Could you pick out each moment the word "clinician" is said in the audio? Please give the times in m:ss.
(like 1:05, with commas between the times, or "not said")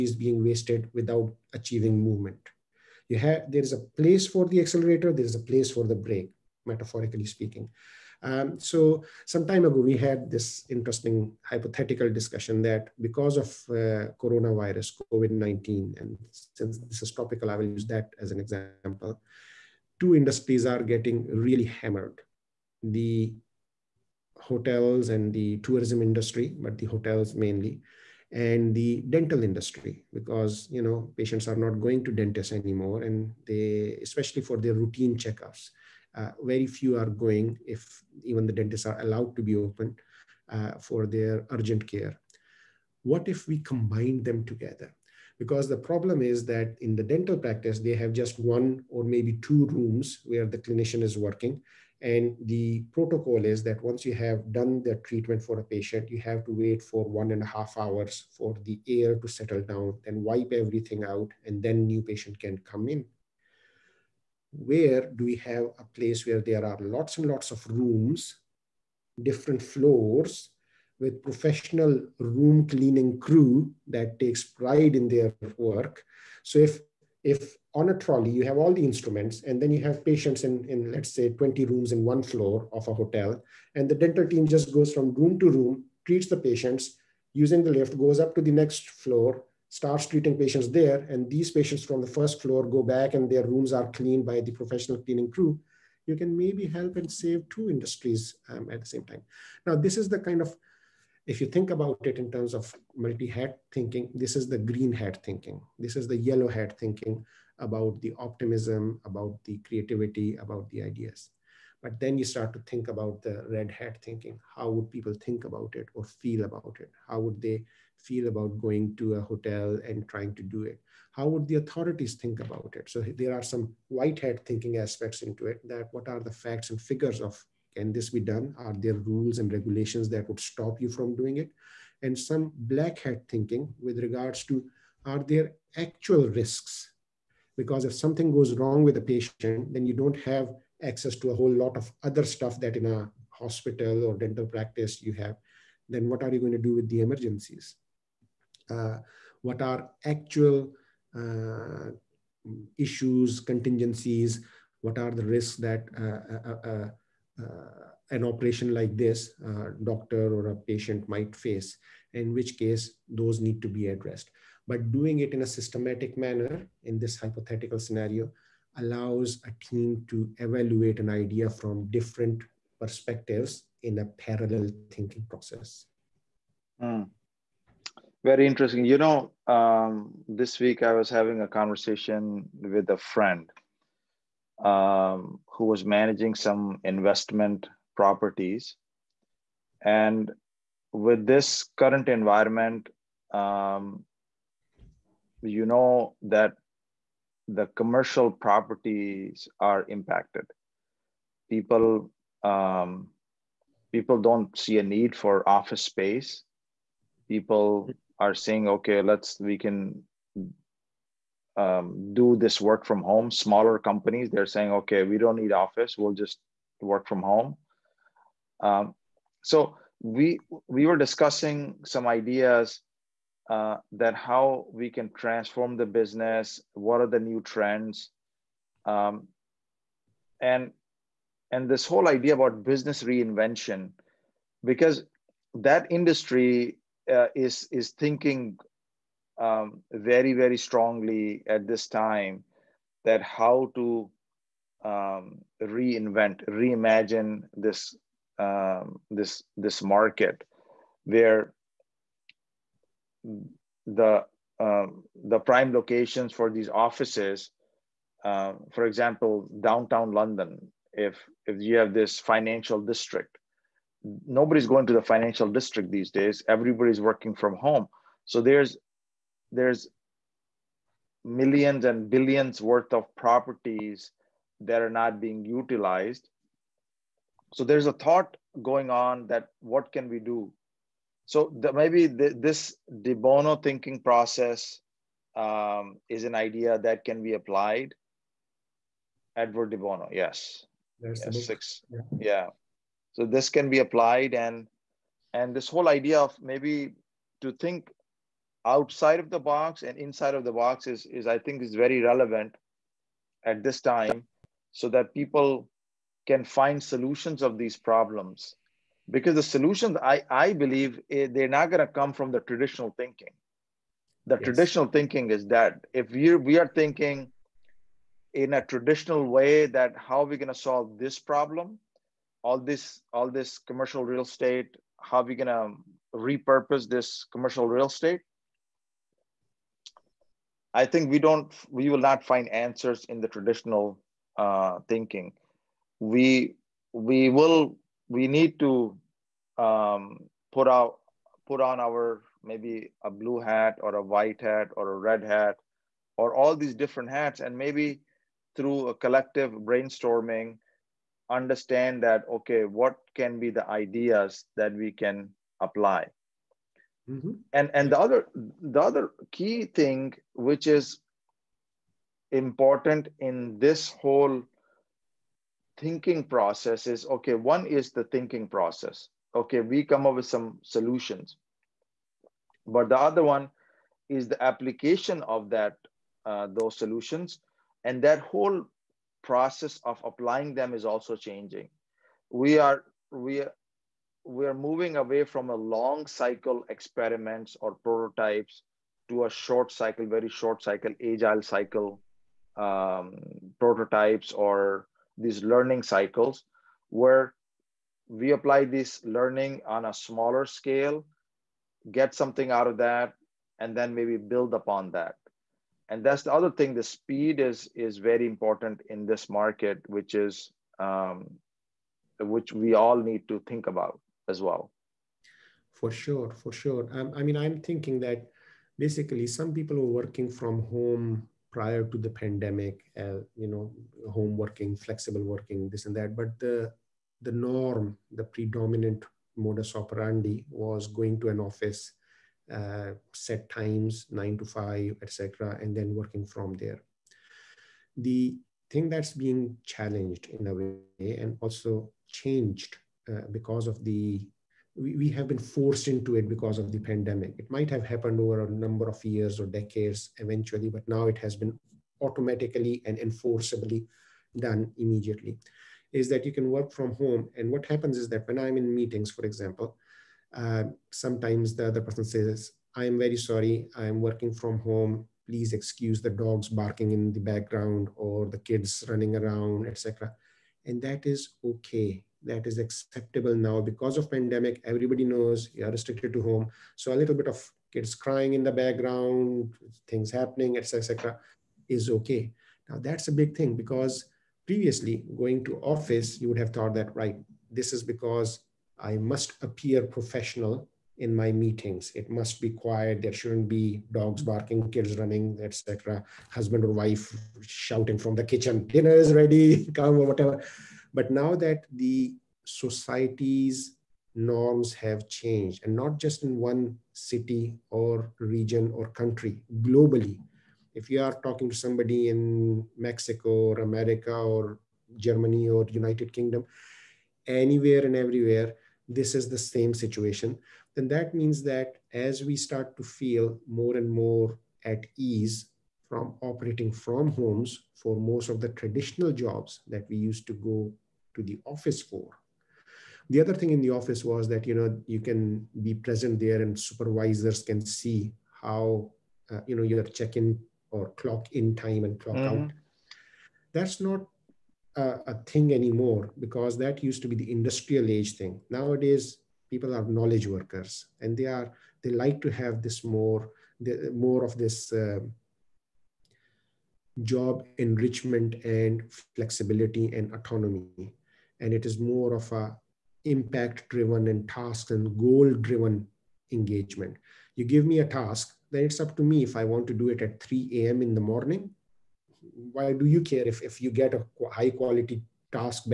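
0:50.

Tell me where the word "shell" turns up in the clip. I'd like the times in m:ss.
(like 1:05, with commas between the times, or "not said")
not said.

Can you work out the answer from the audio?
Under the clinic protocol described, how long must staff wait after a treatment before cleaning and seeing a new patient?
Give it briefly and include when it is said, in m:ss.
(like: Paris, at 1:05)
One and a half hours, at 0:57.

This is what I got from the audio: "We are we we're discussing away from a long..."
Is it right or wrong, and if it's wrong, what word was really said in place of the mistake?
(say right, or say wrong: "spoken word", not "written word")
wrong: "moving", not "discussing".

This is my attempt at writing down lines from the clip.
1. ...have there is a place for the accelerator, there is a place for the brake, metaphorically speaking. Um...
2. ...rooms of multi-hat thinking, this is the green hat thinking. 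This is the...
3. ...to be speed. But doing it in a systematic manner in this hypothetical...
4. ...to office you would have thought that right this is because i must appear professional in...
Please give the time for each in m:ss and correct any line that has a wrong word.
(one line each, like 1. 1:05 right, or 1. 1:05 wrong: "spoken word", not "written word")
1. 0:03 right
2. 1:42 wrong: "terms", not "rooms"
3. 2:43 wrong: "addressed", not "speed"
4. 8:05 right.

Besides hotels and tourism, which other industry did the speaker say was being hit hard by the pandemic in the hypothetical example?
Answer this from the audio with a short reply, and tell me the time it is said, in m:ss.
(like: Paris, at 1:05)
Dental industry, at 0:28.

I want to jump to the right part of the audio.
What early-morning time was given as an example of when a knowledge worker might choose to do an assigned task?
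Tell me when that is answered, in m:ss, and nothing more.
9:30.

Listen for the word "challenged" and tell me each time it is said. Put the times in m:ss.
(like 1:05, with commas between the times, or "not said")
7:19.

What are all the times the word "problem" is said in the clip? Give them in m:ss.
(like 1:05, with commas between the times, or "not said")
0:45, 5:07, 5:21.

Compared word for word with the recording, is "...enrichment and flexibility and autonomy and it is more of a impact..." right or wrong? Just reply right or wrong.
right.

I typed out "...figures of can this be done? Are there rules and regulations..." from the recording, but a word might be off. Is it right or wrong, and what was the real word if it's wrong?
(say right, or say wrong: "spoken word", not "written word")
right.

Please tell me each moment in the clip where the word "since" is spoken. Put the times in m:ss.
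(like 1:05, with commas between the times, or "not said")
0:16.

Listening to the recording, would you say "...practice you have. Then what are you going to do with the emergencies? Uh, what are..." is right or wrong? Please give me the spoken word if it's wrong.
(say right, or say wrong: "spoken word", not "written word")
right.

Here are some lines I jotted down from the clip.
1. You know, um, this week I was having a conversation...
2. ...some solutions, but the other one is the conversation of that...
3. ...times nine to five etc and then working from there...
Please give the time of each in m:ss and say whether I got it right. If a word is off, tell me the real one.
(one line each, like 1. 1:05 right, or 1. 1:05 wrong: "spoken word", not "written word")
1. 2:58 right
2. 6:10 wrong: "application", not "conversation"
3. 7:13 right.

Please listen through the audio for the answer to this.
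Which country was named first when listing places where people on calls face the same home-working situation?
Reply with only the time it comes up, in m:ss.
8:32.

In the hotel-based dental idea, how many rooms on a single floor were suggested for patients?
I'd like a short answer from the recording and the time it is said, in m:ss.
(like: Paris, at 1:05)
20, at 1:21.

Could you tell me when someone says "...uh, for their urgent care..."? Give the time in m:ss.
0:40.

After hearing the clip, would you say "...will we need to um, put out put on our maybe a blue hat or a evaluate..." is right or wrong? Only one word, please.
wrong.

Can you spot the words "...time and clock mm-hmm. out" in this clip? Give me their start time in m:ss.
9:01.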